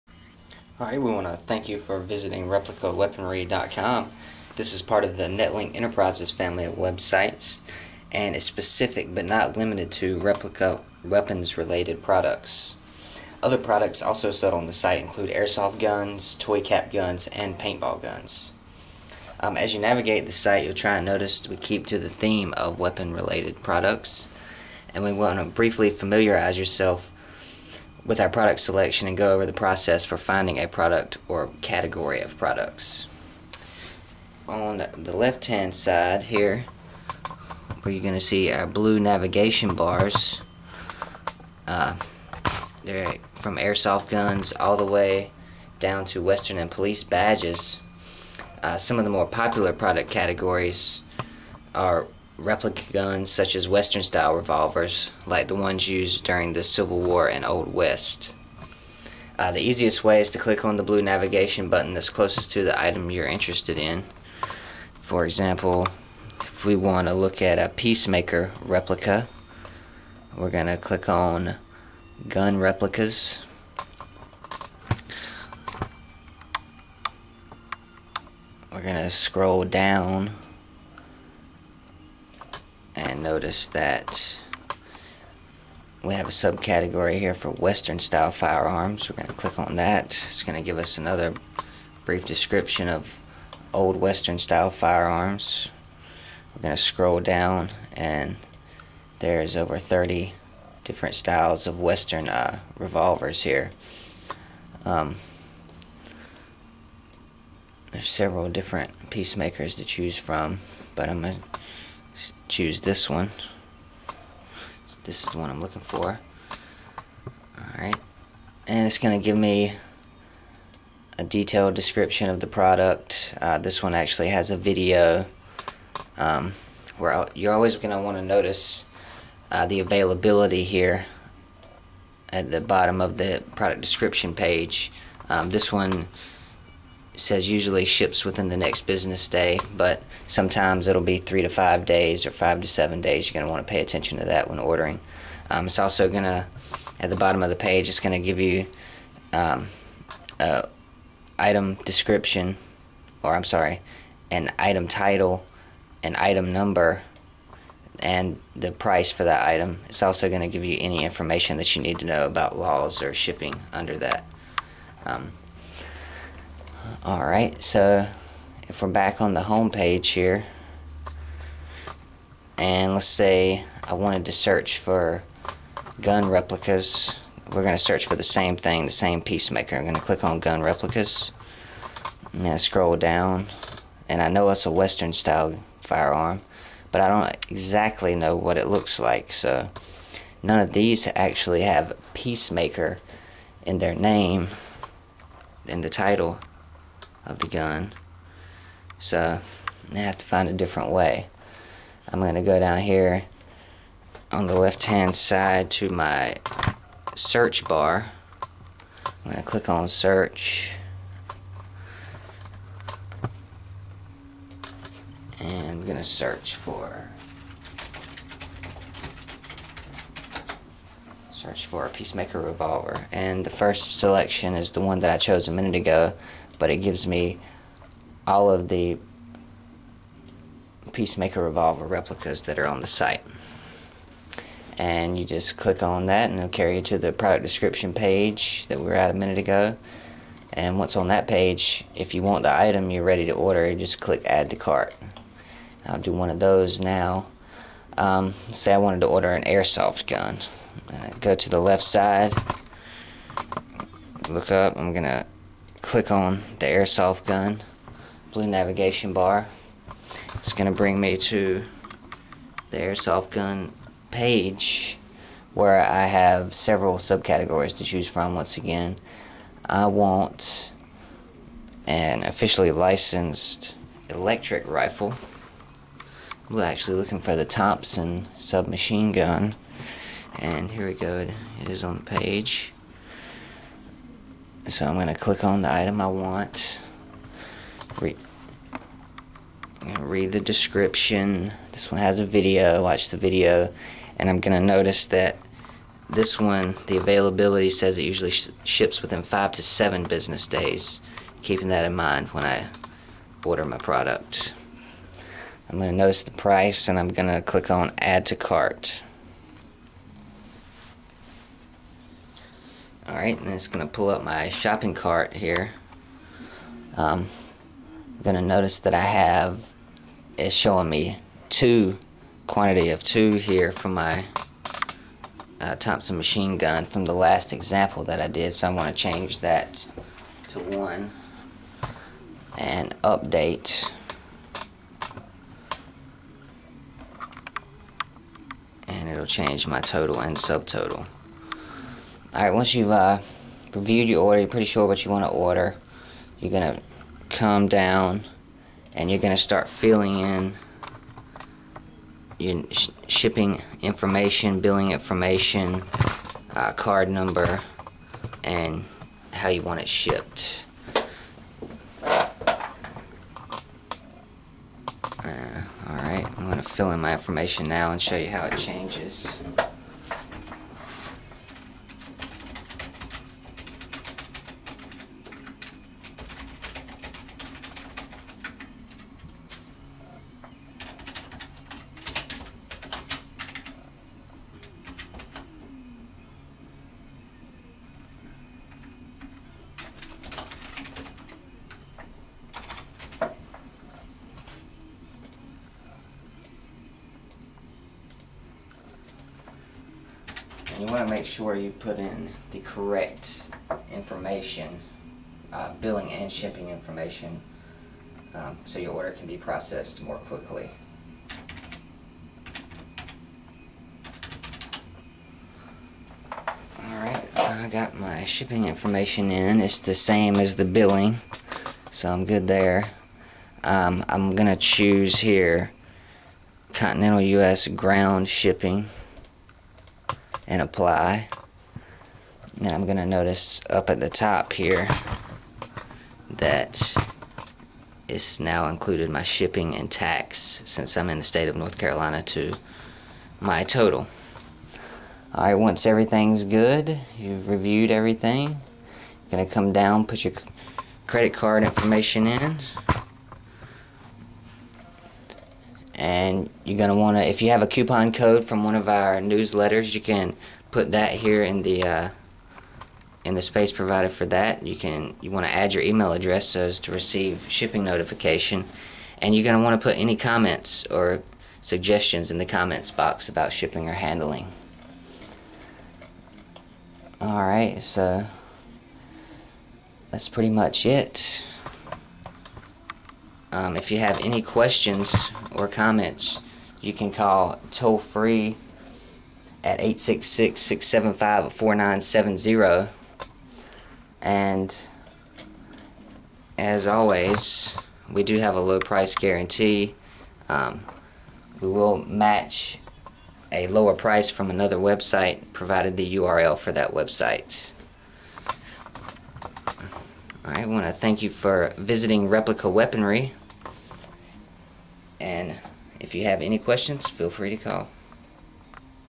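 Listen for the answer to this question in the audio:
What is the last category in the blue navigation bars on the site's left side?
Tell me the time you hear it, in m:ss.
0:46.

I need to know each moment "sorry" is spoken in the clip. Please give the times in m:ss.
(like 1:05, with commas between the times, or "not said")
2:33.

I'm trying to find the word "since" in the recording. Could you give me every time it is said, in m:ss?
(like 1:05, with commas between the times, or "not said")
7:20.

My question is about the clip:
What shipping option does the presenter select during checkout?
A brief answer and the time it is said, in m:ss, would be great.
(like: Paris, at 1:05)
Continental U.S. ground shipping, at 7:06.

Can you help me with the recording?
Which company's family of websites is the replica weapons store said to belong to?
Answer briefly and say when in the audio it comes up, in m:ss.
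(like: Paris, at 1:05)
Netlink Enterprises, at 0:05.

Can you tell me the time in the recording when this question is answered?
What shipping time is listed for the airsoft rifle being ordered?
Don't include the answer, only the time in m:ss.
4:59.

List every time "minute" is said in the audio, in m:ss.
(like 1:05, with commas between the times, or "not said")
3:45, 3:59.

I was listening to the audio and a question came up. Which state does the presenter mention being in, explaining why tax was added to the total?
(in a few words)
North Carolina.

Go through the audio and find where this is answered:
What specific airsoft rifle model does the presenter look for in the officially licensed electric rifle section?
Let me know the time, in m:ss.
4:37.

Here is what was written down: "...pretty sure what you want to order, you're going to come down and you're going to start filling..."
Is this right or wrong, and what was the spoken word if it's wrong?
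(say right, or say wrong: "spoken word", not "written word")
right.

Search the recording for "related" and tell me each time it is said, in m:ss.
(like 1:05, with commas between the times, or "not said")
0:11, 0:23.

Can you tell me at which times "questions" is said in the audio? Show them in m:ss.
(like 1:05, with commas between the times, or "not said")
8:04, 8:36.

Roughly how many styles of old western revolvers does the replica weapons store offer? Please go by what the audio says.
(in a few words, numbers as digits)
over 30.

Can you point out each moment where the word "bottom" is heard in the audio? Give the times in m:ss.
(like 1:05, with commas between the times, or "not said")
2:12, 2:27.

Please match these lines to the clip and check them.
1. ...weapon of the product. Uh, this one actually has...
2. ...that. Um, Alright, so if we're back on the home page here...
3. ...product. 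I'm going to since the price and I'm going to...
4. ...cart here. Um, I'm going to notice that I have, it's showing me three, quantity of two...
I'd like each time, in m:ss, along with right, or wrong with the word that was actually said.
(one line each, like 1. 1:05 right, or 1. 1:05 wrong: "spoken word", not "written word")
1. 2:01 wrong: "description", not "weapon"
2. 2:43 right
3. 5:03 wrong: "notice", not "since"
4. 5:14 wrong: "two", not "three".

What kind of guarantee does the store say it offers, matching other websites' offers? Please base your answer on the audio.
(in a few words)
low price guarantee.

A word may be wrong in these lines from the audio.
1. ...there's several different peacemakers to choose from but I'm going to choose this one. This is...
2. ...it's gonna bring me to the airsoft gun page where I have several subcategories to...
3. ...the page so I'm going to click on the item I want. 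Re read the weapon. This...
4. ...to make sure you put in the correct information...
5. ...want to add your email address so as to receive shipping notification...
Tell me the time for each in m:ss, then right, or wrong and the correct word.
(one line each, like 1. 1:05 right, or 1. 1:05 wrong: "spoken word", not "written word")
1. 1:47 right
2. 4:20 right
3. 4:41 wrong: "description", not "weapon"
4. 6:41 right
5. 7:45 right.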